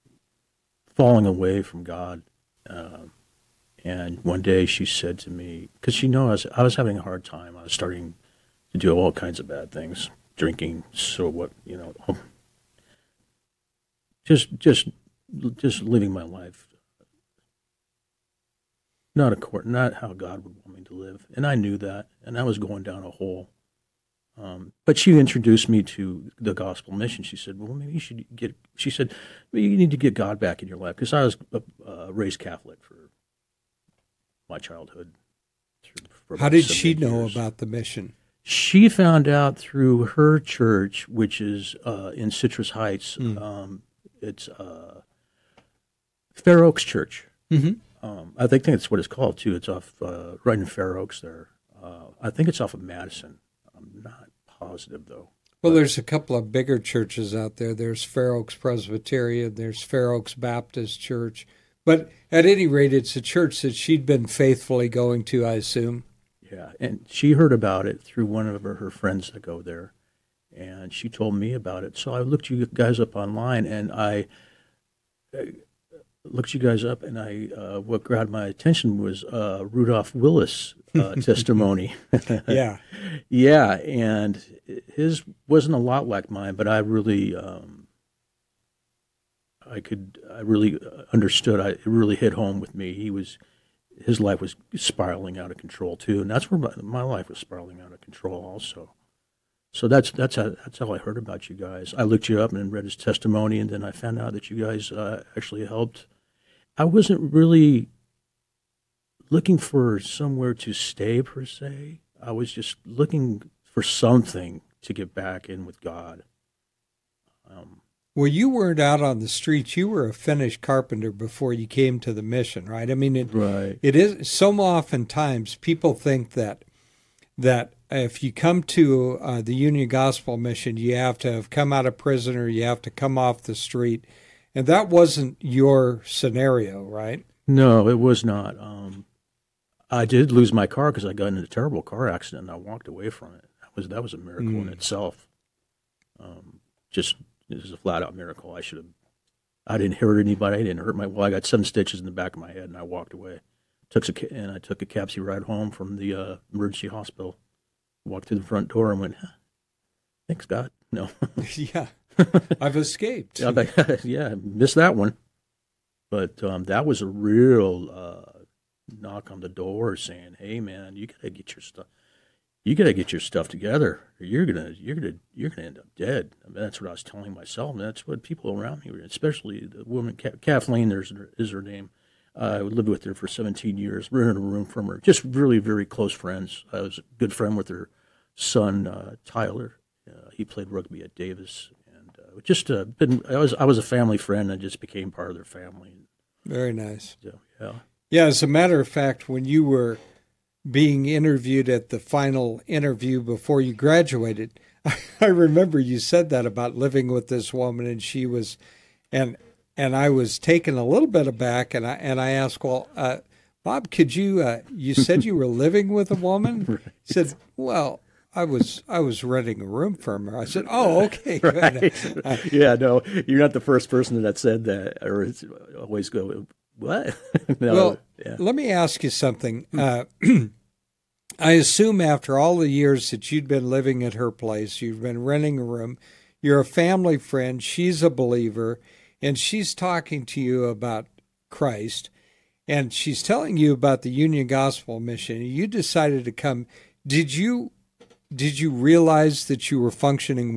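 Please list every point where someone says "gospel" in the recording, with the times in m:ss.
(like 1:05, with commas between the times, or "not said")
0:26, 2:09, 4:04.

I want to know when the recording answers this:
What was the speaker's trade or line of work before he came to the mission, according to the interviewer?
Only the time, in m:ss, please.
2:00.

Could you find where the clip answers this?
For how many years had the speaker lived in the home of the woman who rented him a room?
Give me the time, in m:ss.
3:03.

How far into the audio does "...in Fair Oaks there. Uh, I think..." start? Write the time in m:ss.
0:50.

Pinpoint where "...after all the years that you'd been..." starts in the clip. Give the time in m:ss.
3:52.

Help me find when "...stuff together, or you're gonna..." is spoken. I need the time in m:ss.
2:53.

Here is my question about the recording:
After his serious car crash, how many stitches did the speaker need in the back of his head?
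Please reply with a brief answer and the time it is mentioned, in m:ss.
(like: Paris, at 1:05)
7, at 2:31.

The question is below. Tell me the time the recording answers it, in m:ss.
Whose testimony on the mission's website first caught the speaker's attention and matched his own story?
1:19.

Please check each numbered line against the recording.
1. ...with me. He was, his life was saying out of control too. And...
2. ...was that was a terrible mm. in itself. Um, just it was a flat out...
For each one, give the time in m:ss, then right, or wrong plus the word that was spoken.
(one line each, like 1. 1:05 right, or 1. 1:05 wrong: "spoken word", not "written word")
1. 1:32 wrong: "spiraling", not "saying"
2. 2:23 wrong: "miracle", not "terrible".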